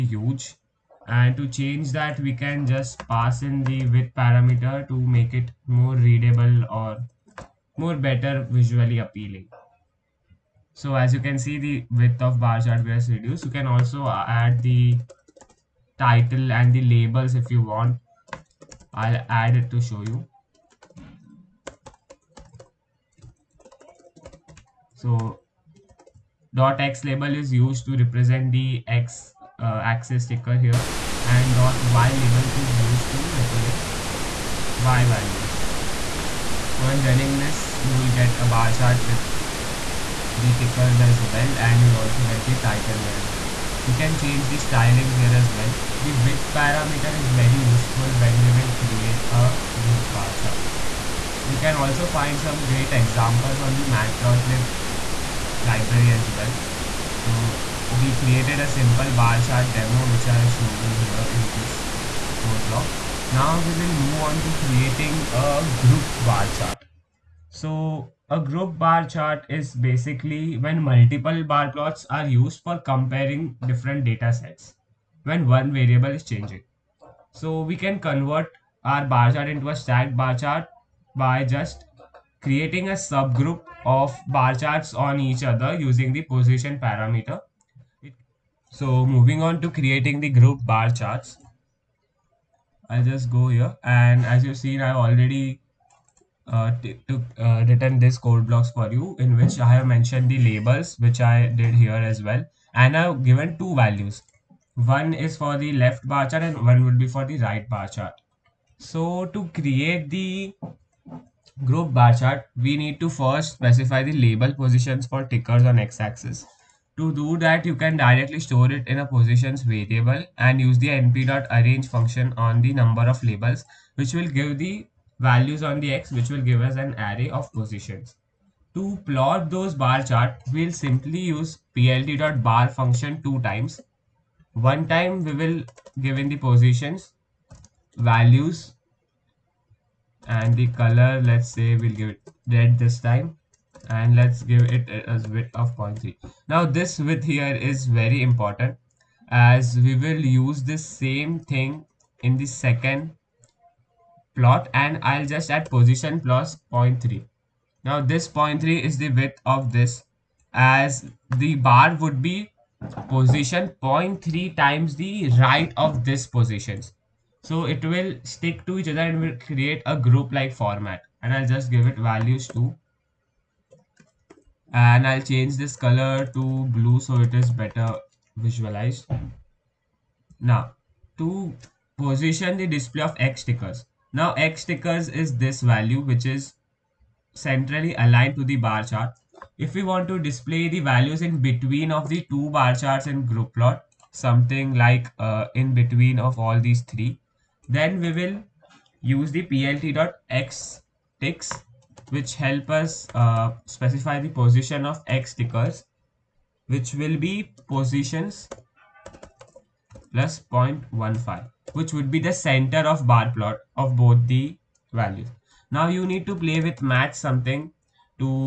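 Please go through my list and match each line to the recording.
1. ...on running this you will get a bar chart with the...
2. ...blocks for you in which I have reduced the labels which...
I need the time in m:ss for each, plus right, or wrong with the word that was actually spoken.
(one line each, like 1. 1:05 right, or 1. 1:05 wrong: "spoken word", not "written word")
1. 0:36 right
2. 1:38 wrong: "mentioned", not "reduced".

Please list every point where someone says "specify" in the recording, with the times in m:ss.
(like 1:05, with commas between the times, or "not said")
1:53, 3:23.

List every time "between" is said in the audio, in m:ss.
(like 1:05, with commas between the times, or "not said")
3:11, 3:15.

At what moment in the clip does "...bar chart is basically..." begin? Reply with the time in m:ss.
1:08.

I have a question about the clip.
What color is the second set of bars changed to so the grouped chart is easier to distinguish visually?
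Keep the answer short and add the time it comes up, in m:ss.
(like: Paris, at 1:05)
blue, at 2:56.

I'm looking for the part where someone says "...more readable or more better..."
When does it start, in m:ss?
0:05.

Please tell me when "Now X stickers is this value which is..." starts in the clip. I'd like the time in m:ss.
3:04.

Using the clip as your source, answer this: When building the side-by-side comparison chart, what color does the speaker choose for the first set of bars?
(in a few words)
red.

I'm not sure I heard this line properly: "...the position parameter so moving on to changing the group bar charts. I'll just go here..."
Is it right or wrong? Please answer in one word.
wrong.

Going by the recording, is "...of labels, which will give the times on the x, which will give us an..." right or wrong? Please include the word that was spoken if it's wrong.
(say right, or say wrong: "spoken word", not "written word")
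wrong: "values", not "times".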